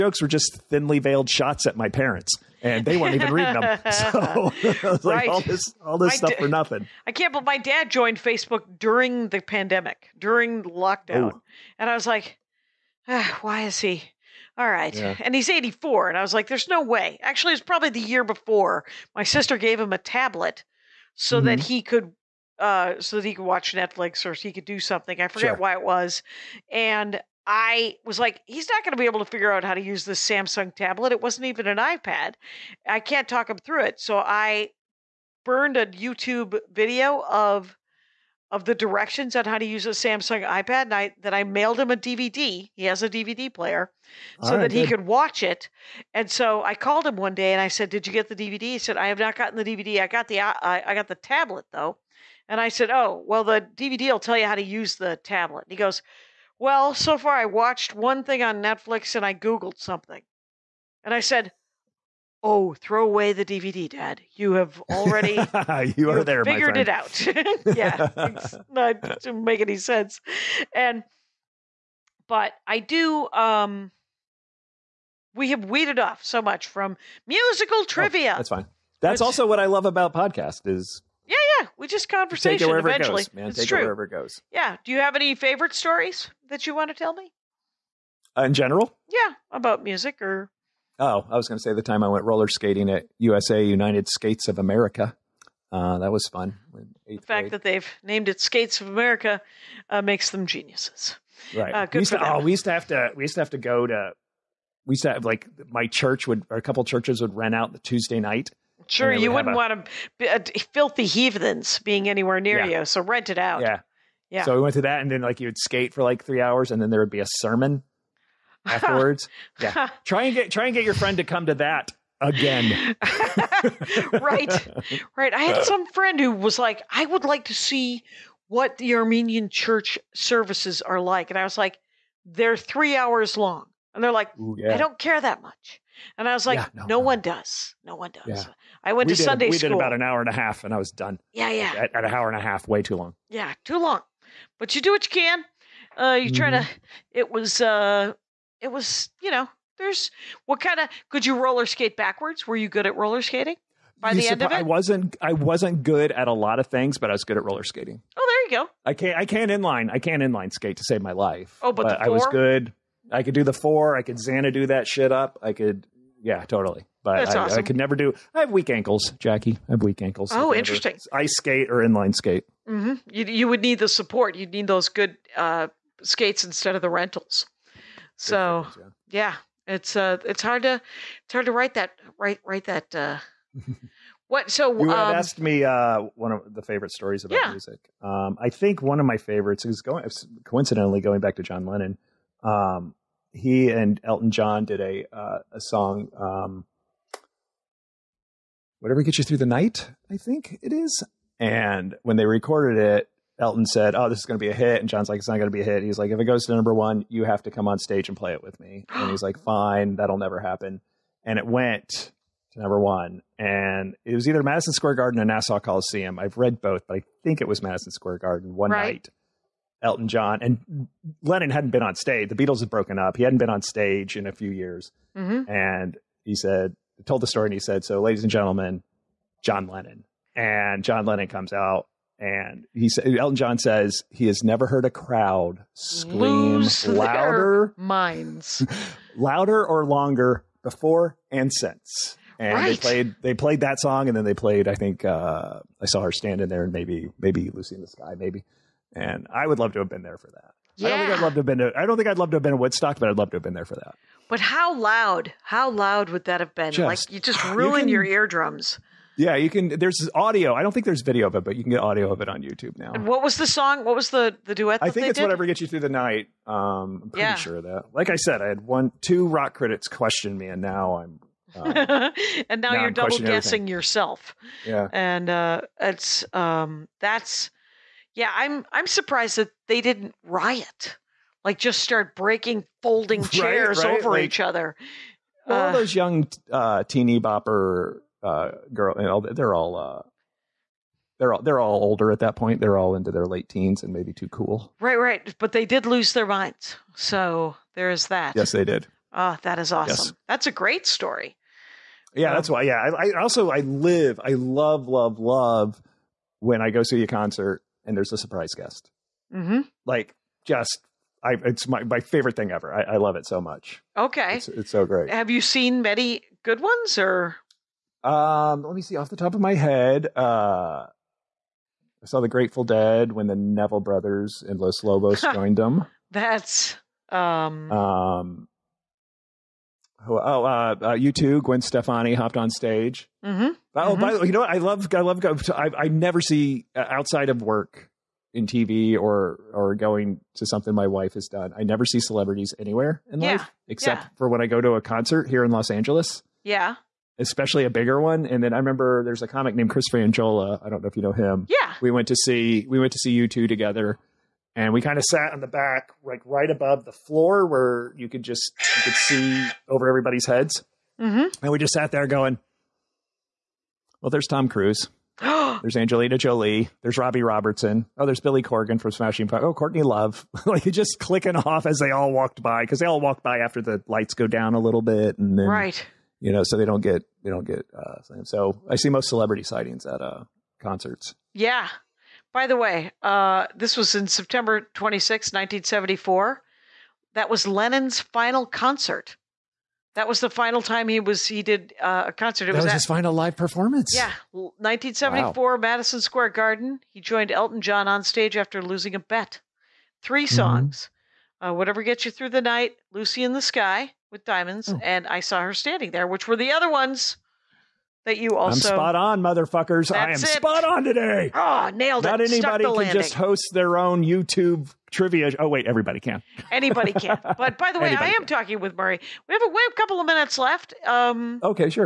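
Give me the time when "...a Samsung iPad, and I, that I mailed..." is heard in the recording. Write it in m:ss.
0:39.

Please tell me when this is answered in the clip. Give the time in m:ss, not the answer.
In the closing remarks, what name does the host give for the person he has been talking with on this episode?
6:58.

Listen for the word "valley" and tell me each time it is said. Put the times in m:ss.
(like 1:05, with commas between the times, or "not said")
not said.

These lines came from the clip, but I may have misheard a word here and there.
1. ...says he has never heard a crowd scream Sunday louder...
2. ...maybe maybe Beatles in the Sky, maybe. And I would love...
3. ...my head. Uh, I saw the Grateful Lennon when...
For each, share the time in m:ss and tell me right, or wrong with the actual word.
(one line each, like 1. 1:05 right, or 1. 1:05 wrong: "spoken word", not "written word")
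1. 3:53 wrong: "Lose", not "Sunday"
2. 4:06 wrong: "Lucy", not "Beatles"
3. 5:19 wrong: "Dead", not "Lennon".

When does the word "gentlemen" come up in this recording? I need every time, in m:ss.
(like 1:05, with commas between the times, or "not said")
3:48.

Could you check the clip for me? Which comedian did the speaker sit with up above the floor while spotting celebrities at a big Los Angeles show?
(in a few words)
Chris Franjola.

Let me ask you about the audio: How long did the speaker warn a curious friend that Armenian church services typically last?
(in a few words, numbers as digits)
3 hours.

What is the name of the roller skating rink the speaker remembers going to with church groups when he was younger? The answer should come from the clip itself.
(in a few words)
United Skates of America.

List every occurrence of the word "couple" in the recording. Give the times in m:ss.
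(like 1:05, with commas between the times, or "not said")
1:46, 6:59.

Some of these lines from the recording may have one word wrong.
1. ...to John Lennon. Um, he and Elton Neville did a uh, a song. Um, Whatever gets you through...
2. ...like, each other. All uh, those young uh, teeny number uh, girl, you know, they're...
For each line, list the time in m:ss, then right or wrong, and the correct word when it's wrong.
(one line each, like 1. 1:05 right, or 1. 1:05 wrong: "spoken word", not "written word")
1. 3:11 wrong: "John", not "Neville"
2. 4:44 wrong: "bopper", not "number".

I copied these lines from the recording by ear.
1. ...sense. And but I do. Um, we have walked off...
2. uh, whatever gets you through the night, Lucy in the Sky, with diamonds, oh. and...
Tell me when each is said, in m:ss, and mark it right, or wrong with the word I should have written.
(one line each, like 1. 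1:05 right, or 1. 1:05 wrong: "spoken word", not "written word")
1. 1:09 wrong: "weeded", not "walked"
2. 6:41 right.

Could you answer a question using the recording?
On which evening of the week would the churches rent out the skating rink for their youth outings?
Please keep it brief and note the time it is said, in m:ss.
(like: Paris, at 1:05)
Tuesday night, at 1:47.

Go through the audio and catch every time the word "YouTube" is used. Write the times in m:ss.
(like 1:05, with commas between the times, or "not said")
0:35, 4:22, 6:54.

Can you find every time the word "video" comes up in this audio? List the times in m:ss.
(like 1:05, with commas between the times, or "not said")
0:36, 4:21.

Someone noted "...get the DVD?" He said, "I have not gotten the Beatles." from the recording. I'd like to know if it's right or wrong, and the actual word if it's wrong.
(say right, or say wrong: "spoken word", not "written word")
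wrong: "DVD", not "Beatles".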